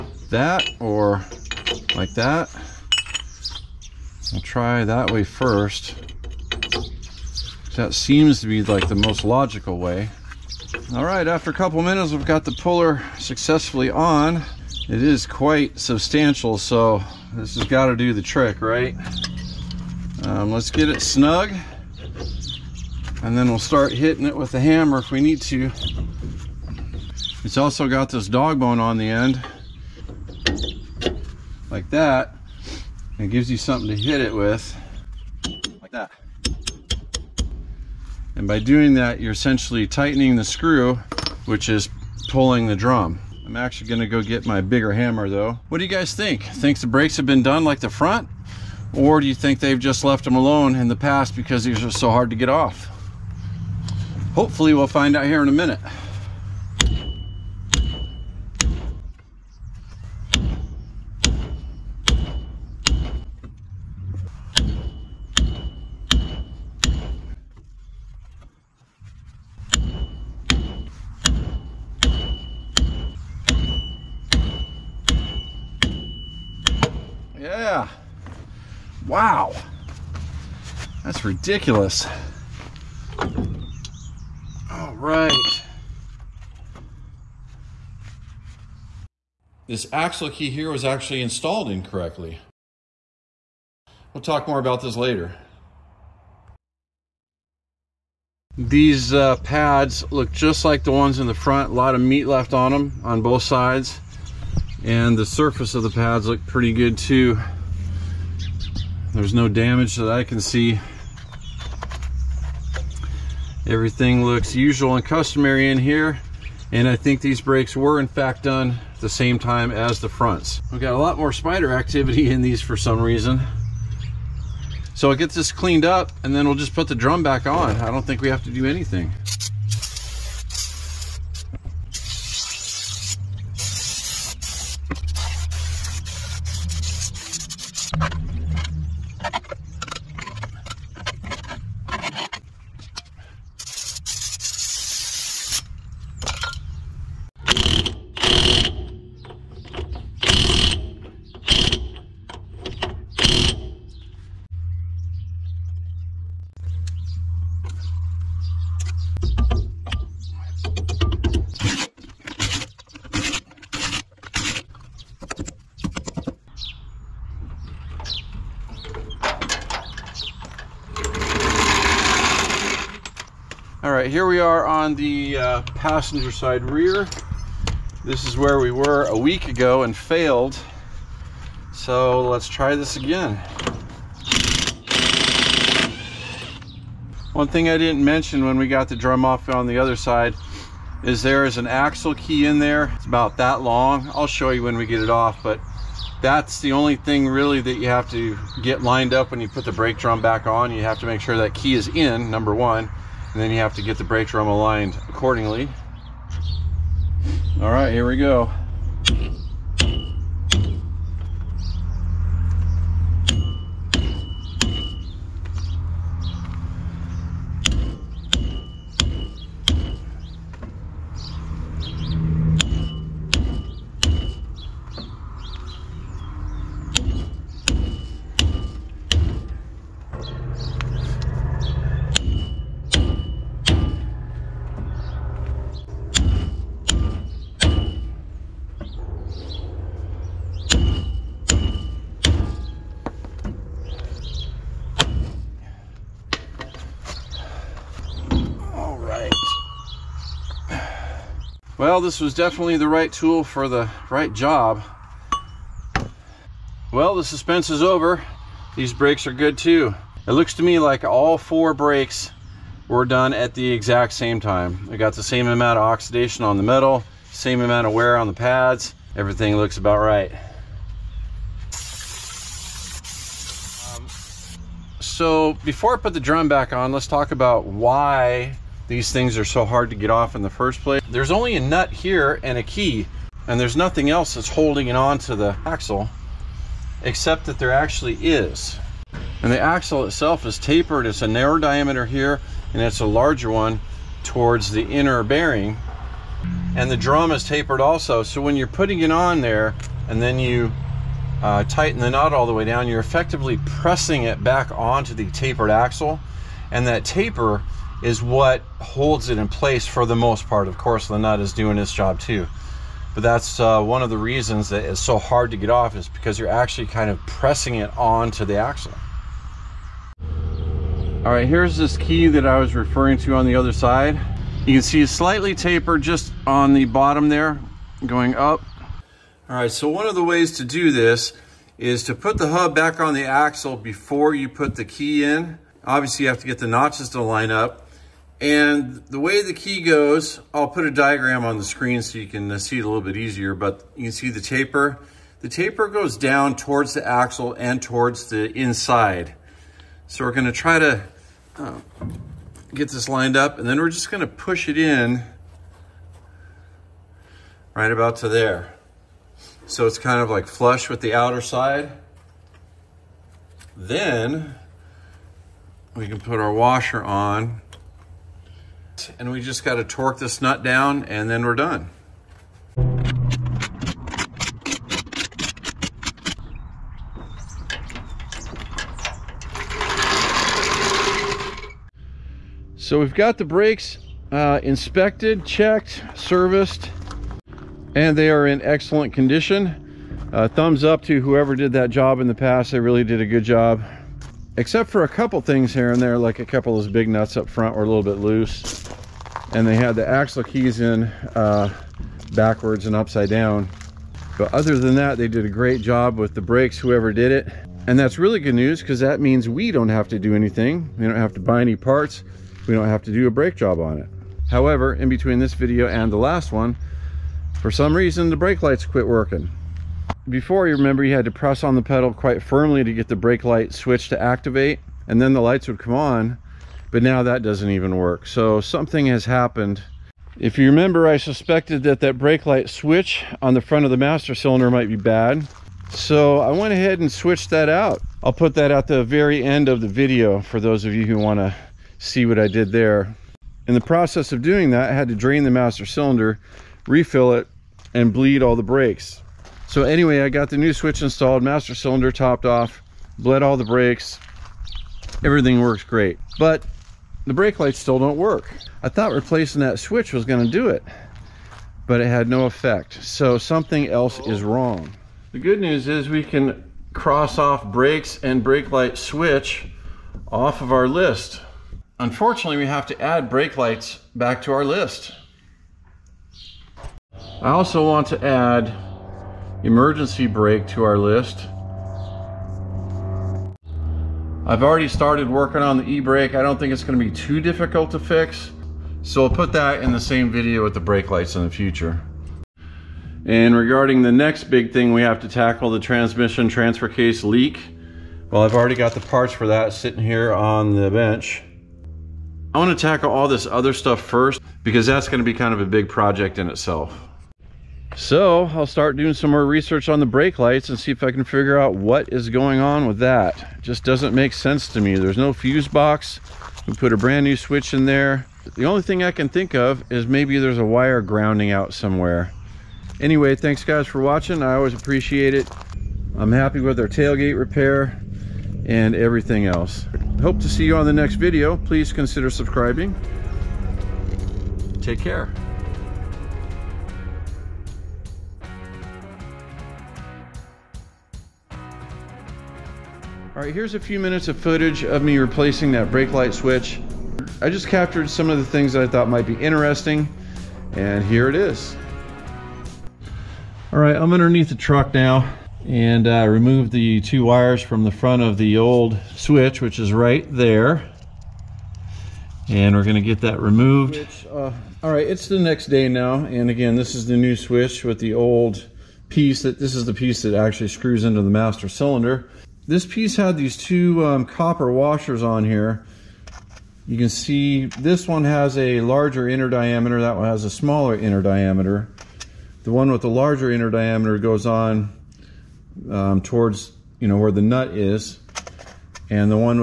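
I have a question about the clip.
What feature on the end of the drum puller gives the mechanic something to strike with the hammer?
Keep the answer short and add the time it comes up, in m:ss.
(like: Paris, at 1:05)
dog bone, at 0:28.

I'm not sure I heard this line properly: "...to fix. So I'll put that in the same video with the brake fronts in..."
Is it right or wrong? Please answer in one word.
wrong.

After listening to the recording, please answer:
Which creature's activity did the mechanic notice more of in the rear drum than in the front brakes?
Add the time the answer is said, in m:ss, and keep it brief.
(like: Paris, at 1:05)
spider, at 2:01.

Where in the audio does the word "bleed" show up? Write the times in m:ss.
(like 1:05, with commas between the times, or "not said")
7:28.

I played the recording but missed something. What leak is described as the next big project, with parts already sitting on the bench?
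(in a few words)
transmission transfer case.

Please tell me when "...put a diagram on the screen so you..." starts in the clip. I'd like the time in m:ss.
5:40.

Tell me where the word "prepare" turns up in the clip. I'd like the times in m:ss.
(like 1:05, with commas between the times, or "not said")
not said.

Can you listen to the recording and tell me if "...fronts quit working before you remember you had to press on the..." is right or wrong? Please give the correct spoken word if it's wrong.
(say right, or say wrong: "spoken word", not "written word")
wrong: "lights", not "fronts".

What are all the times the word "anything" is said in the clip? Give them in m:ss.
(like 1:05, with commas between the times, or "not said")
2:08, 6:50.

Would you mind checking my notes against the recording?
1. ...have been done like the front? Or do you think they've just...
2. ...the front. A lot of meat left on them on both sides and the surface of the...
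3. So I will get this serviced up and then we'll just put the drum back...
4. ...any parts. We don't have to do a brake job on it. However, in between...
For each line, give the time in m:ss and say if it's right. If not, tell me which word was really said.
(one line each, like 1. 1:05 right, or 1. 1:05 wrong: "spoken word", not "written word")
1. 0:47 right
2. 1:41 right
3. 2:04 wrong: "cleaned", not "serviced"
4. 6:51 right.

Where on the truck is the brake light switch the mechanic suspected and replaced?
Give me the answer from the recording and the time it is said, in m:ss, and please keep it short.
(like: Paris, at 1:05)
front of the master cylinder, at 7:13.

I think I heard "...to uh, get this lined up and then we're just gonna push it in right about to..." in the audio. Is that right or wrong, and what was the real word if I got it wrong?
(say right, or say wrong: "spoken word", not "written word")
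right.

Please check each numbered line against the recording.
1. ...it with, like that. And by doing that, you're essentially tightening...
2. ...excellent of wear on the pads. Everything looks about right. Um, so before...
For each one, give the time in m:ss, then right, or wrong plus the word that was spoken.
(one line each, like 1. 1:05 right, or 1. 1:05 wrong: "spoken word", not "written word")
1. 0:34 right
2. 4:27 wrong: "amount", not "excellent".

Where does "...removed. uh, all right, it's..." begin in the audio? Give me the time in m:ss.
9:23.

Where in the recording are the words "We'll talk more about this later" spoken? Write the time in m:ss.
1:34.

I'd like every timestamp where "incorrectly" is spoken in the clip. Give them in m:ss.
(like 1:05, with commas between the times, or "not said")
1:31.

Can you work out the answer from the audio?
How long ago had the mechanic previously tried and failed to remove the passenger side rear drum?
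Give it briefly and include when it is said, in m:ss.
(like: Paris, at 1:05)
a week, at 2:59.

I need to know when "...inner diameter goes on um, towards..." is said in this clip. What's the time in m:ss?
9:43.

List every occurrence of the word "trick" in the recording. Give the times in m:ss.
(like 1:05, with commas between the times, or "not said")
0:18.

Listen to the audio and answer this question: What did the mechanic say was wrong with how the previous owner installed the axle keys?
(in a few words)
backwards and upside down.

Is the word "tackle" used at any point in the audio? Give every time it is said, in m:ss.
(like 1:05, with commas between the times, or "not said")
8:15, 8:22.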